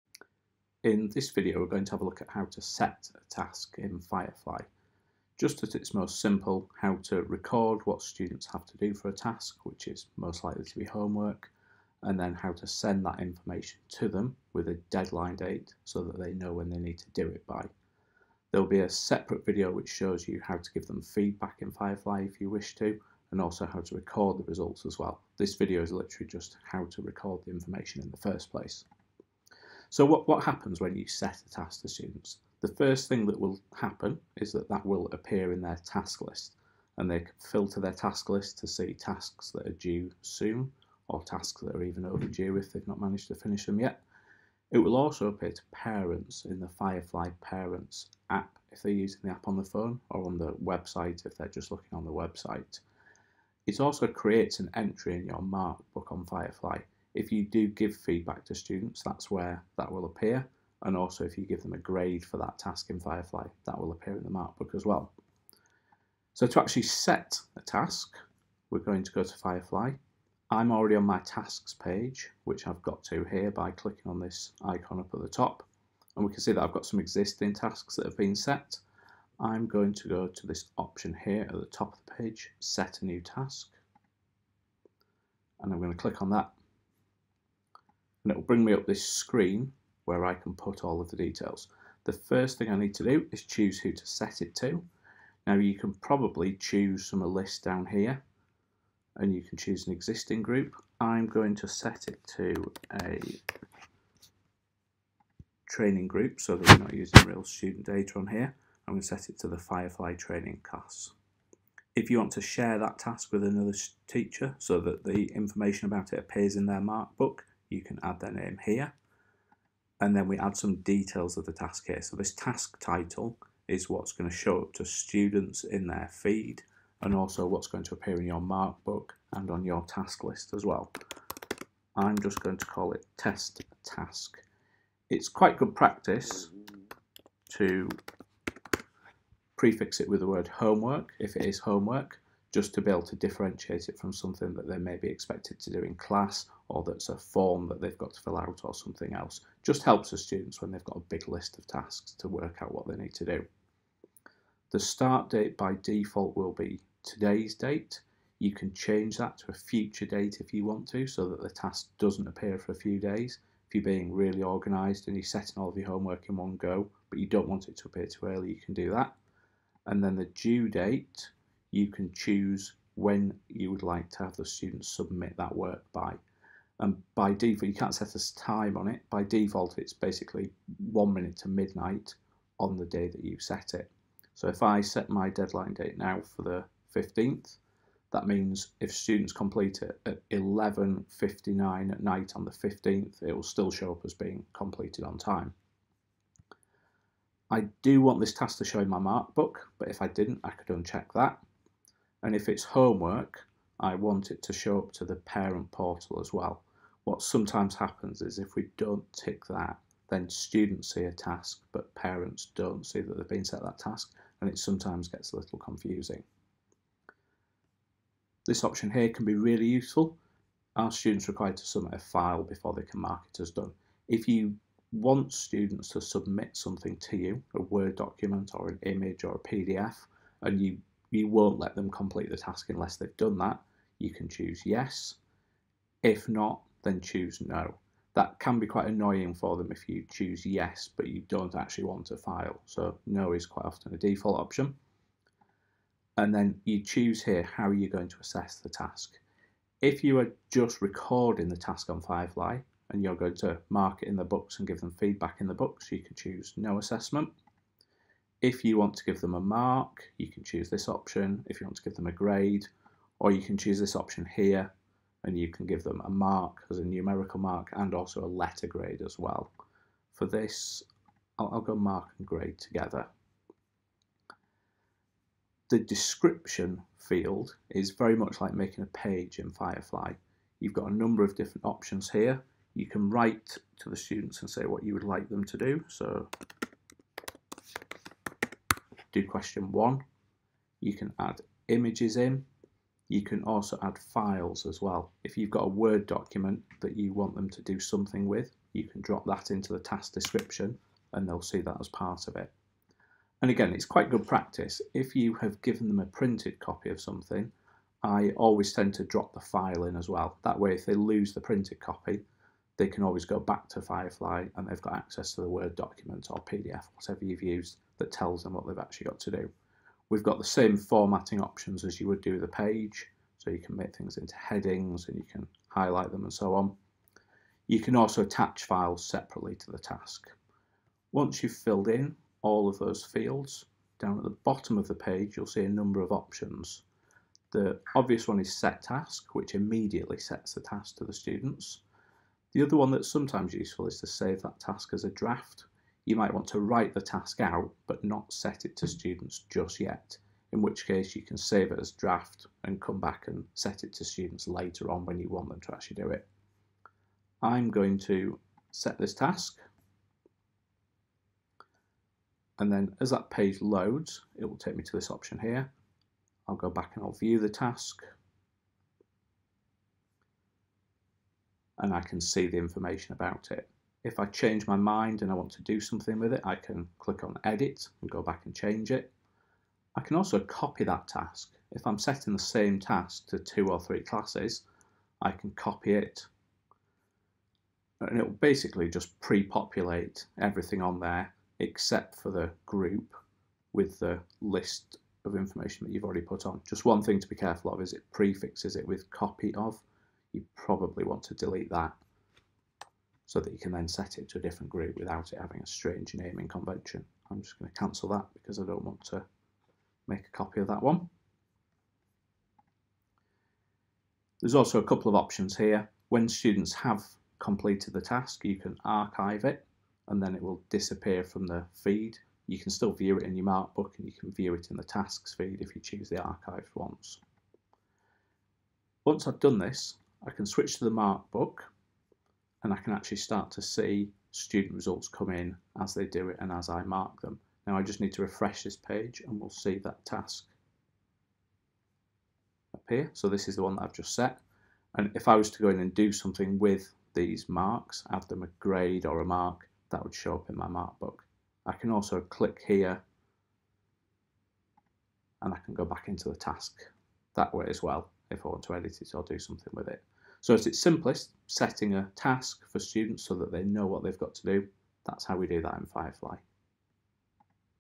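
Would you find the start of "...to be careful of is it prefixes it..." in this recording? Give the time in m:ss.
6:37.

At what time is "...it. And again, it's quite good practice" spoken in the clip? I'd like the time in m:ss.
5:02.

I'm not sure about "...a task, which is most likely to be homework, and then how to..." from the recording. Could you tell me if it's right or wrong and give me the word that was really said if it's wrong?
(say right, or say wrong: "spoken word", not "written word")
right.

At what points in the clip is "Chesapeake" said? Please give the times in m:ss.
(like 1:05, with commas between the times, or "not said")
not said.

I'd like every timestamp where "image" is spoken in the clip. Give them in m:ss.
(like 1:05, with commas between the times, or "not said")
3:48, 4:51.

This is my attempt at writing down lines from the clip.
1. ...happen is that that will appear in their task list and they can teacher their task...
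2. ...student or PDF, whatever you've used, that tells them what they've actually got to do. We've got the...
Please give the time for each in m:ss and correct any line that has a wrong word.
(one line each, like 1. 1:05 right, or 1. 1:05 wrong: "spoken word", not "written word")
1. 0:33 wrong: "filter", not "teacher"
2. 5:15 wrong: "document", not "student".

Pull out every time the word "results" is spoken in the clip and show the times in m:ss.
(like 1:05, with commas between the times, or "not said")
0:24, 7:14.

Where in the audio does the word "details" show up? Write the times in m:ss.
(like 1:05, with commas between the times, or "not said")
1:31, 2:00.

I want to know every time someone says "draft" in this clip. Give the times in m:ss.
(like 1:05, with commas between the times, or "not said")
5:45, 5:51.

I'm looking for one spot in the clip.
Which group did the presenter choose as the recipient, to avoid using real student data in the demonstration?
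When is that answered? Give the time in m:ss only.
1:49.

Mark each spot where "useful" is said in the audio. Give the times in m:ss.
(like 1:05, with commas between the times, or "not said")
3:39, 5:43.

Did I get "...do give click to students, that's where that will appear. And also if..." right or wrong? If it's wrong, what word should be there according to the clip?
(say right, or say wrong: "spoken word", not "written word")
wrong: "feedback", not "click".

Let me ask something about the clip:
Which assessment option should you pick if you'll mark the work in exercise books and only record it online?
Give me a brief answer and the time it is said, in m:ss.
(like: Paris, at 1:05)
no assessment, at 4:16.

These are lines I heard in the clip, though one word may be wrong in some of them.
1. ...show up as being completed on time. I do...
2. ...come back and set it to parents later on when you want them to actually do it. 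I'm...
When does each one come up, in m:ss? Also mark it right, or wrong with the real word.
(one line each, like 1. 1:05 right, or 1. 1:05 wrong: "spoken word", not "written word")
1. 3:13 right
2. 5:52 wrong: "students", not "parents".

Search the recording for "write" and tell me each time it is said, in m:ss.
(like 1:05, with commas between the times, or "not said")
4:43, 5:46.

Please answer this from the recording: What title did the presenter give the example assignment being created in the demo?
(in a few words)
test task.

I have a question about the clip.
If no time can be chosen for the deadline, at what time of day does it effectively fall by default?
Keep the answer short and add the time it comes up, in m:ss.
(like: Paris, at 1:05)
11:59 at night, at 3:00.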